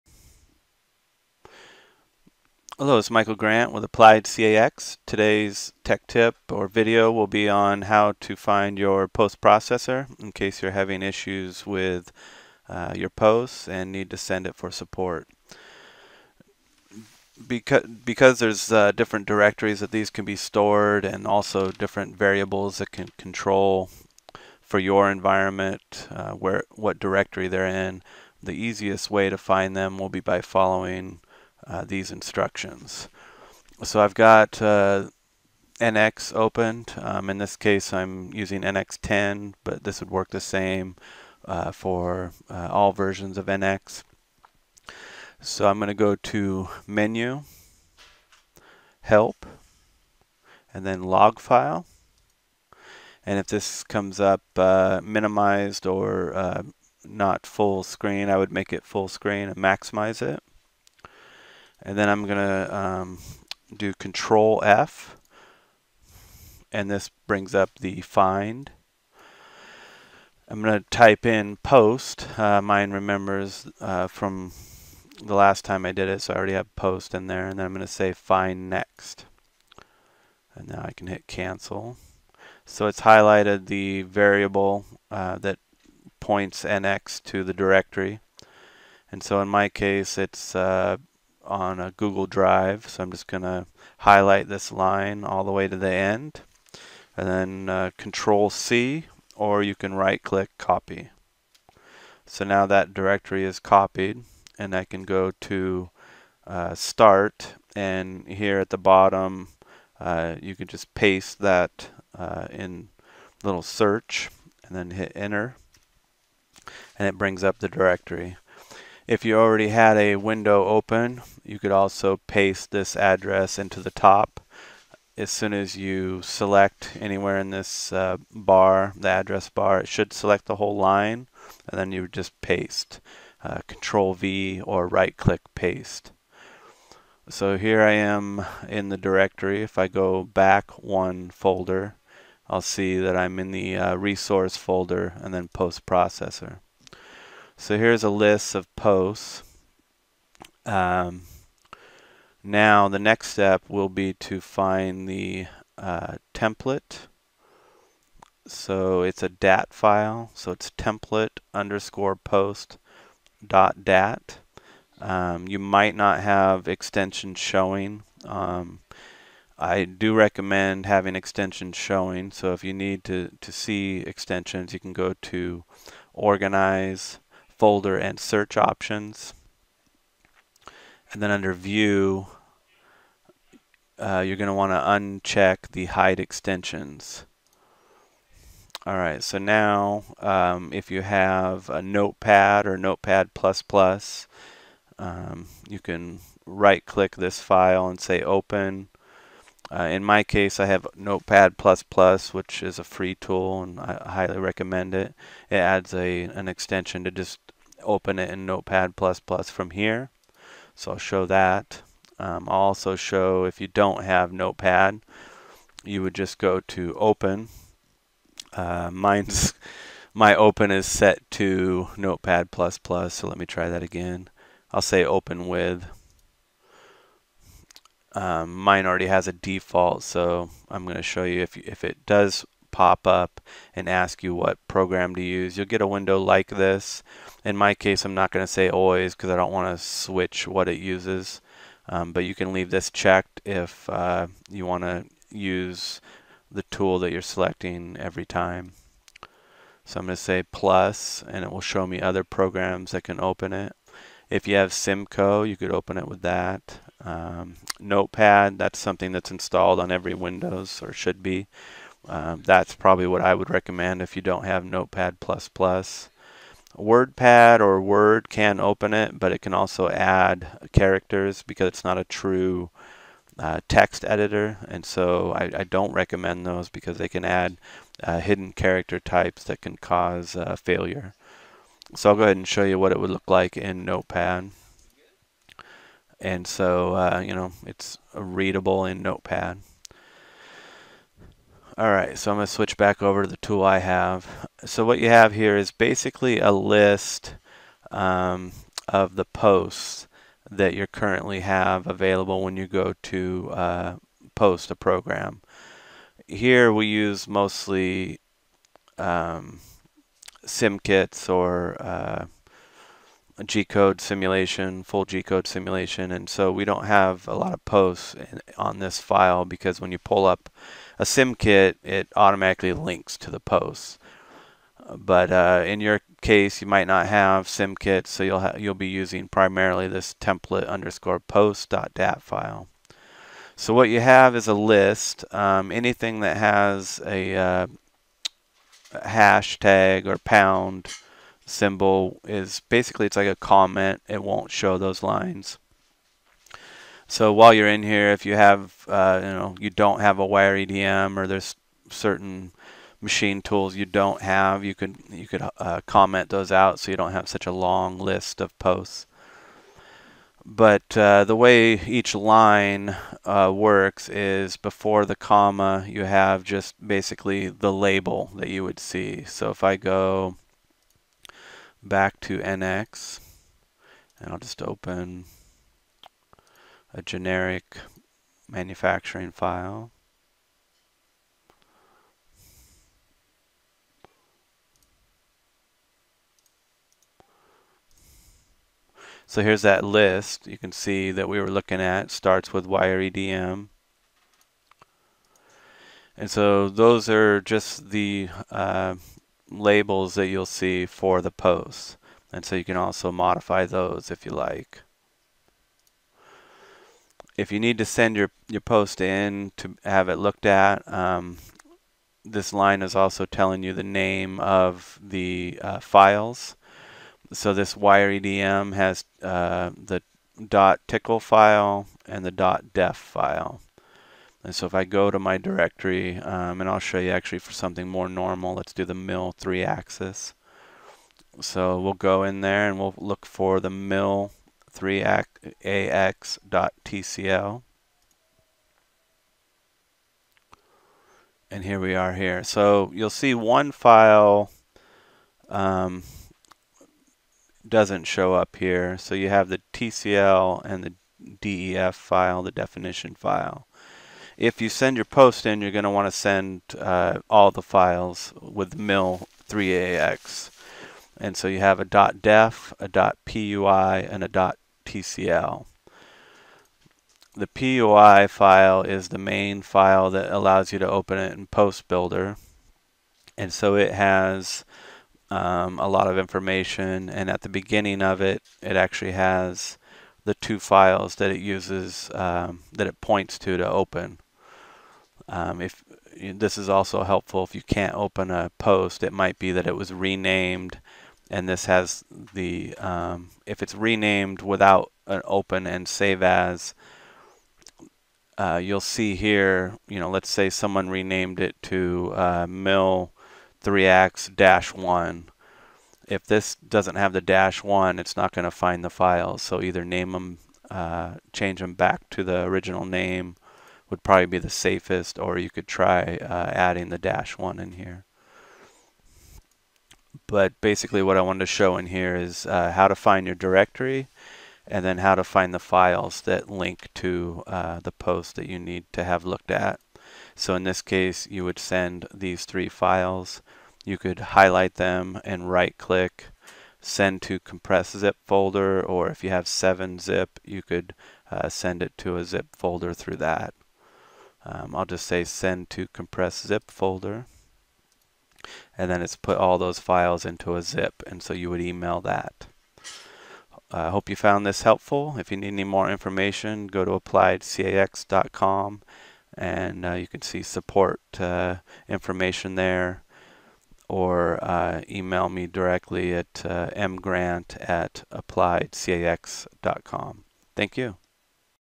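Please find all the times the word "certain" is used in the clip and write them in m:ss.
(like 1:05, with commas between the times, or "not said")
5:51.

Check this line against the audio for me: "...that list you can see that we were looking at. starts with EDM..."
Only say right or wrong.
right.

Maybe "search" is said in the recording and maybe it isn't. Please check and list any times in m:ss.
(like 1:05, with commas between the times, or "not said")
1:53, 2:58.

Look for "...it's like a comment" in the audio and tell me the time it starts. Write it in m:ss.
5:43.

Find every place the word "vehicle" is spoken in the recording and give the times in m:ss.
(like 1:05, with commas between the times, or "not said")
not said.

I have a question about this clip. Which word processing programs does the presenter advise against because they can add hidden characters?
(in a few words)
WordPad or Word.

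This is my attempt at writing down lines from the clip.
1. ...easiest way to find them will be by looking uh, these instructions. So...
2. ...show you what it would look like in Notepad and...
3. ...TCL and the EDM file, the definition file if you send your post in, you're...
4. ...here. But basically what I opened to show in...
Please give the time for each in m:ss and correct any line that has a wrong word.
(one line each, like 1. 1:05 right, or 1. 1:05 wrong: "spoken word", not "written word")
1. 0:28 wrong: "following", not "looking"
2. 4:42 right
3. 7:29 wrong: "DEF", not "EDM"
4. 8:37 wrong: "wanted", not "opened".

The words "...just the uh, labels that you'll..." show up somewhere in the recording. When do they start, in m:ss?
6:37.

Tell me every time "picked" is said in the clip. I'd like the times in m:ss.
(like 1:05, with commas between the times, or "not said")
not said.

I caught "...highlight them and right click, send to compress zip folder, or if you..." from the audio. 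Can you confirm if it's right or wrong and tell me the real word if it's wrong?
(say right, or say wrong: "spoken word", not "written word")
right.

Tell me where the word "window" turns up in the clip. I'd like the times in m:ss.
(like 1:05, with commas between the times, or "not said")
2:00, 3:55, 4:20.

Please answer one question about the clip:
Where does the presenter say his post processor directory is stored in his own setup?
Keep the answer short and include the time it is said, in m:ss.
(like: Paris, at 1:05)
Google Drive, at 1:31.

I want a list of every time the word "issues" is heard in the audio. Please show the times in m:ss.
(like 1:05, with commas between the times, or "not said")
0:11.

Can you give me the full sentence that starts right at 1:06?
And this brings up the find.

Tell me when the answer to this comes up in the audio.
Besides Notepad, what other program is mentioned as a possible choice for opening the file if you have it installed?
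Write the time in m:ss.
4:14.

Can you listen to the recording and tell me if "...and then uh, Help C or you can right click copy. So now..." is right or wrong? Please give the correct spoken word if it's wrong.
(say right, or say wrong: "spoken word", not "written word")
wrong: "Control", not "Help".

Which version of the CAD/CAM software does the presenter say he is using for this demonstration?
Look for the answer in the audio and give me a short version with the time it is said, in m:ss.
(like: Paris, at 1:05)
NX10, at 0:38.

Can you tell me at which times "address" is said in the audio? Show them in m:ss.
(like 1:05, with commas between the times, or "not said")
2:02, 2:09.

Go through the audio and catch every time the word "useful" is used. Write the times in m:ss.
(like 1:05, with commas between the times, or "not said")
not said.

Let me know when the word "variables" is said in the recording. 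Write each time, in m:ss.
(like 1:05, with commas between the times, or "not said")
0:22, 1:24.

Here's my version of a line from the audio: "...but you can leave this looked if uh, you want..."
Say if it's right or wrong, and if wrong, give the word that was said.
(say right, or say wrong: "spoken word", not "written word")
wrong: "checked", not "looked".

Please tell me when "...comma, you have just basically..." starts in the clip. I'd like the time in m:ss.
6:05.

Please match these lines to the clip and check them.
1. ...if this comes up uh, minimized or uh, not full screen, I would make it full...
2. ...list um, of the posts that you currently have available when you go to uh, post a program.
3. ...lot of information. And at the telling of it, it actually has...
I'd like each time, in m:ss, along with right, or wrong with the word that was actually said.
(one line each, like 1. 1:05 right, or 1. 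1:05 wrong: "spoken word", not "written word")
1. 0:53 right
2. 4:56 right
3. 7:55 wrong: "beginning", not "telling".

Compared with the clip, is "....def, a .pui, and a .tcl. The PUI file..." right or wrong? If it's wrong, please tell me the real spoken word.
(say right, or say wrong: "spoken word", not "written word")
right.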